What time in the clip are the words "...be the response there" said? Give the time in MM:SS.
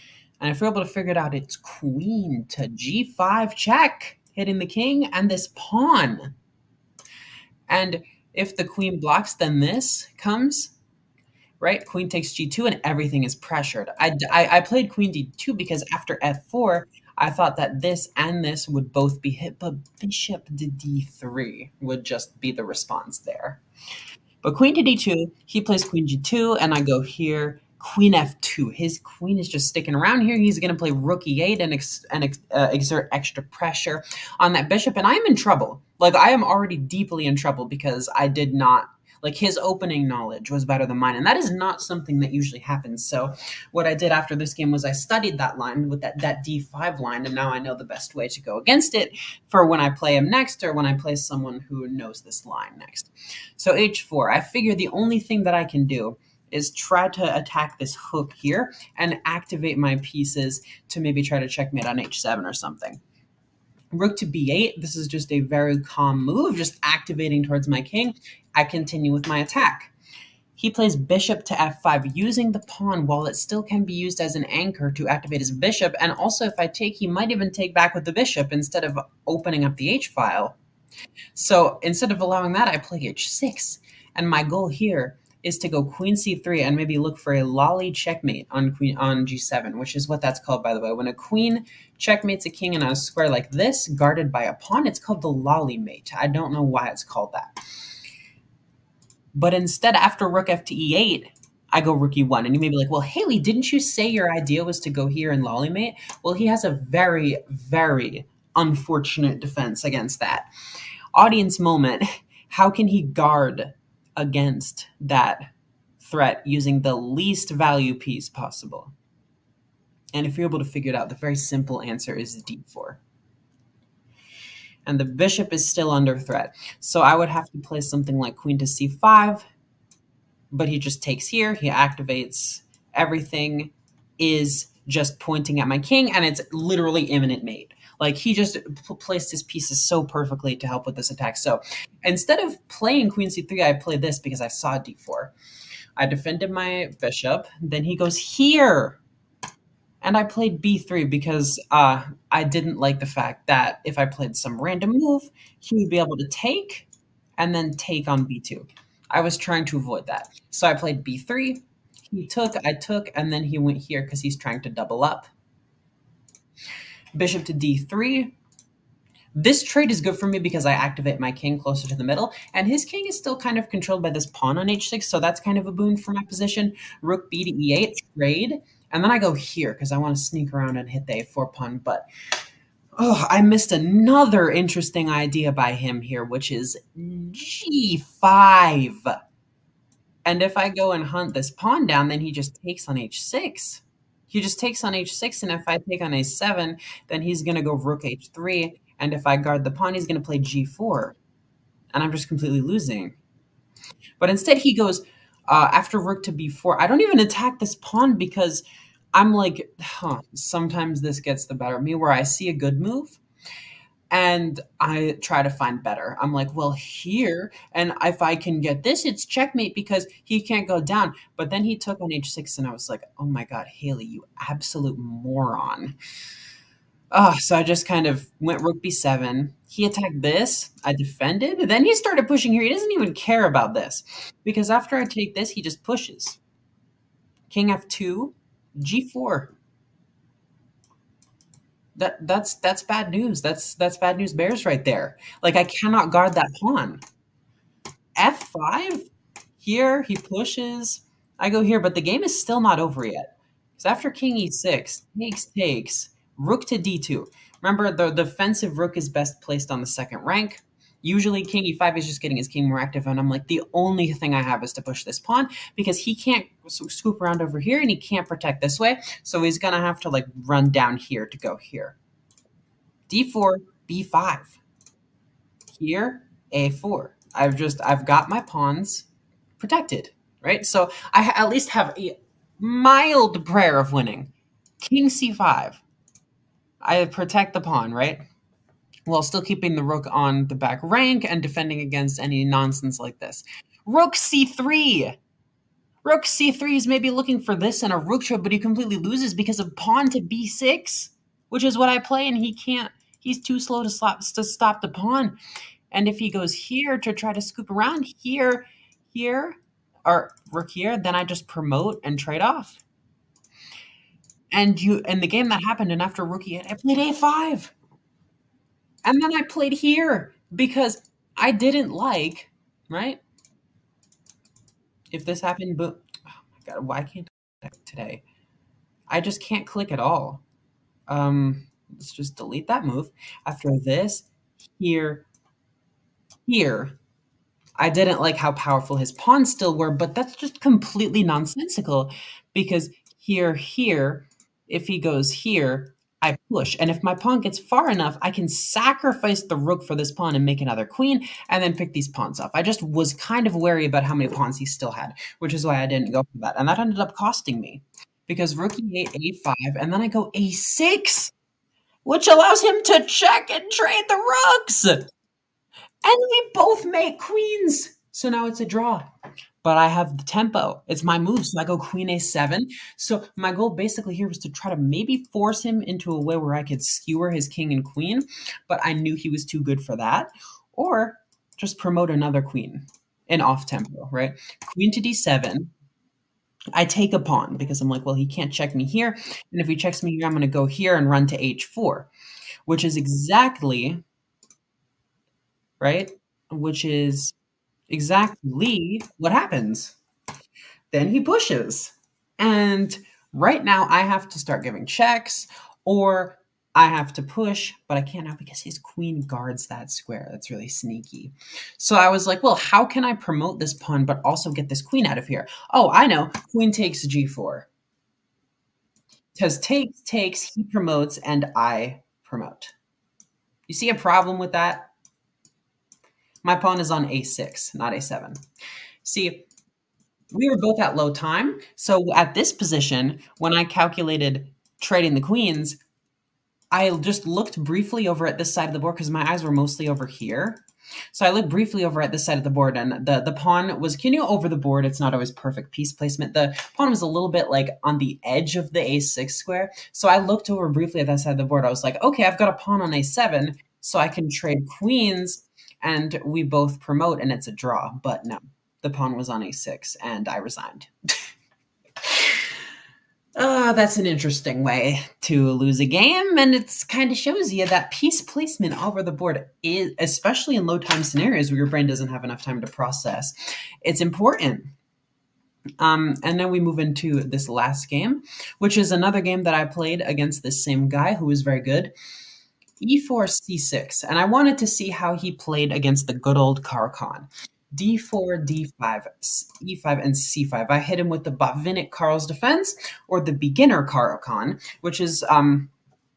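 00:22.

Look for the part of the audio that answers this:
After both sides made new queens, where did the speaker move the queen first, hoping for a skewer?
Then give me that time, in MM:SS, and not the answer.
06:11.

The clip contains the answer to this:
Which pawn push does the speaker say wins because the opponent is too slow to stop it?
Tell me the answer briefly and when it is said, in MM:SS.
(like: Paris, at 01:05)
b6, at 04:59.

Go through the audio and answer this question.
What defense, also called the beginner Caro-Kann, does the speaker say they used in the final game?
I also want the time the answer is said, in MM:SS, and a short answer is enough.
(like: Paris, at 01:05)
Botvinnik-Carls defense, at 08:11.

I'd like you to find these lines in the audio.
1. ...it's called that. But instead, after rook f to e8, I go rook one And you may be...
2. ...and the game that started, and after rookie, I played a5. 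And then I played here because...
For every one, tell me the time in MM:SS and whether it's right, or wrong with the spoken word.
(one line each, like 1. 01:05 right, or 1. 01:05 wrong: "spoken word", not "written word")
1. 01:36 right
2. 05:15 wrong: "happened", not "started".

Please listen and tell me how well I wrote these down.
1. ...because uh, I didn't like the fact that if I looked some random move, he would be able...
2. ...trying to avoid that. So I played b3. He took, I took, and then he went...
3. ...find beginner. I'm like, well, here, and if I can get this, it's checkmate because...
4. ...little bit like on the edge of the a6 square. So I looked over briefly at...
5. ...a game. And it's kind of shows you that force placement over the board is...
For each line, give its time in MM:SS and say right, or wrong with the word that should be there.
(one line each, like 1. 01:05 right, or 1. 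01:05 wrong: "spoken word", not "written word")
1. 02:31 wrong: "played", not "looked"
2. 02:39 right
3. 03:35 wrong: "better", not "beginner"
4. 07:27 right
5. 07:45 wrong: "piece", not "force".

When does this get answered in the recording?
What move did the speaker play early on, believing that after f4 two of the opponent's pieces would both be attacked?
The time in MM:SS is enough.
00:14.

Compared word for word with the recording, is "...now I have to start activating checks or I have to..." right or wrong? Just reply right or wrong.
wrong.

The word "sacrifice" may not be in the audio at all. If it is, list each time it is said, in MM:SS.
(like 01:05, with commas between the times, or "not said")
05:48.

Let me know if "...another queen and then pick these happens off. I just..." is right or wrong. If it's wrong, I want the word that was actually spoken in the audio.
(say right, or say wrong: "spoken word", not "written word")
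wrong: "pawns", not "happens".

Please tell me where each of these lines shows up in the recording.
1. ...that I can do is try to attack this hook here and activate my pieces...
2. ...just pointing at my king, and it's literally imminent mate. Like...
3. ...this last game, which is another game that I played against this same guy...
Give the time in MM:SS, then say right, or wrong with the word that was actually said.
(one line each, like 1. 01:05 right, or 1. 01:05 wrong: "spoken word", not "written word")
1. 00:55 right
2. 02:14 right
3. 07:57 right.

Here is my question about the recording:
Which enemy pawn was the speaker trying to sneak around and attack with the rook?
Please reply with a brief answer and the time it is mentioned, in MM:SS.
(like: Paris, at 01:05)
a4 pawn, at 03:01.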